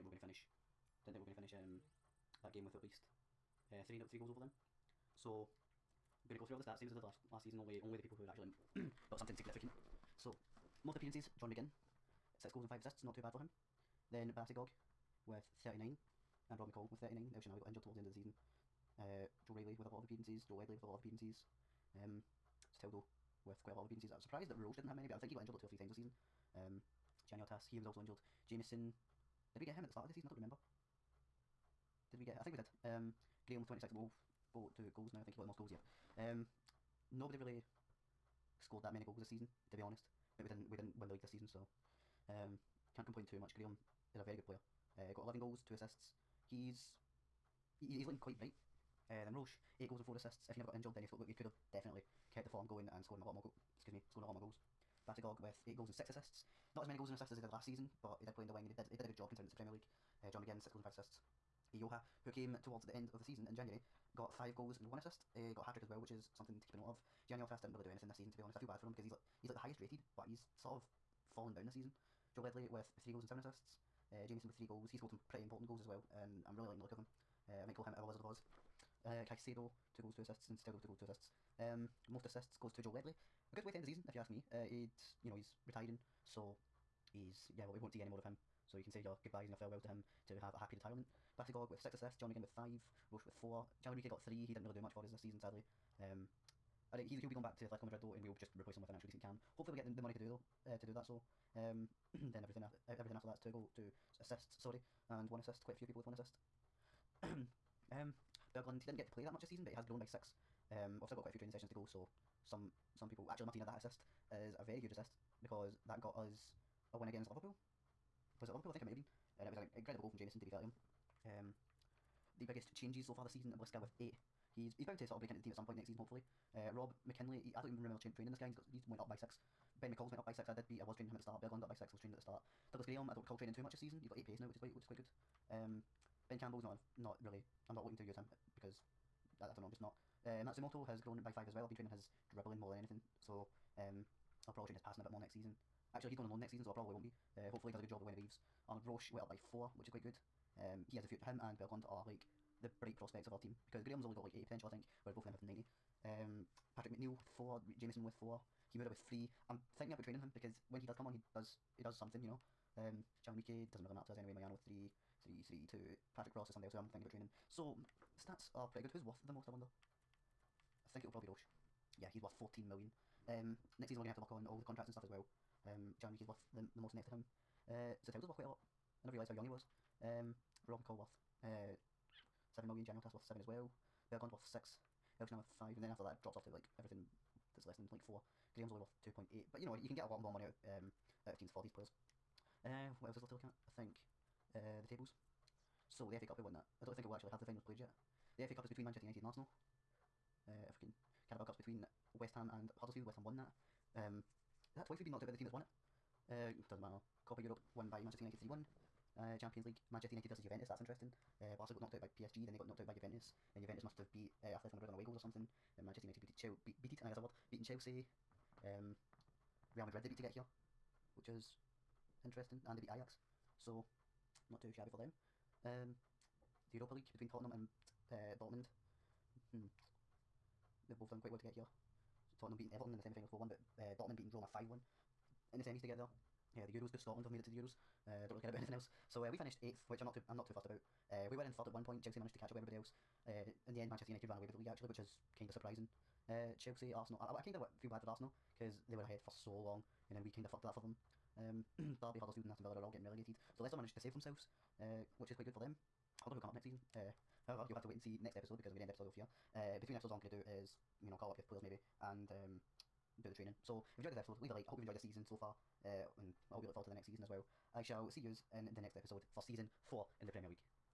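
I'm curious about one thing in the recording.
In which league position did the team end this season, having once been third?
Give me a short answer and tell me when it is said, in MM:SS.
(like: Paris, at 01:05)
8th, at 03:59.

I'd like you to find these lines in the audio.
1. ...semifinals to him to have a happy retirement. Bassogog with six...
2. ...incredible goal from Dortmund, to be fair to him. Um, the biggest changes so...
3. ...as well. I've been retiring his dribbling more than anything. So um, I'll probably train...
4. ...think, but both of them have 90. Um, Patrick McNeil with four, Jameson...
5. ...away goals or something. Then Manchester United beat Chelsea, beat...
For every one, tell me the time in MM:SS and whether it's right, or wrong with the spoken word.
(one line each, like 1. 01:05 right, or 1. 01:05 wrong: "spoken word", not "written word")
1. 01:29 wrong: "farewells", not "semifinals"
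2. 01:59 wrong: "Jameson", not "Dortmund"
3. 02:21 wrong: "training", not "retiring"
4. 02:34 right
5. 03:34 right.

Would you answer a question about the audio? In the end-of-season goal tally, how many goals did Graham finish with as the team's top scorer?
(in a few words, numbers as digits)
11.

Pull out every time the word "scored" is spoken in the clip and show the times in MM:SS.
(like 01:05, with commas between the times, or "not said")
00:38, 00:53, 01:14.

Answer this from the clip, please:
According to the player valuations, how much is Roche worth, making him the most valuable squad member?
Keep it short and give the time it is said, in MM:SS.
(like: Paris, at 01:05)
14 million, at 02:52.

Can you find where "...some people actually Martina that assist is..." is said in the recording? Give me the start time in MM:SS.
01:52.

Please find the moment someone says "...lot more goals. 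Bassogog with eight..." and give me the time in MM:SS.
00:54.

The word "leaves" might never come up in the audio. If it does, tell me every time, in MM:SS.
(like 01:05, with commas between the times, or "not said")
02:28, 04:24.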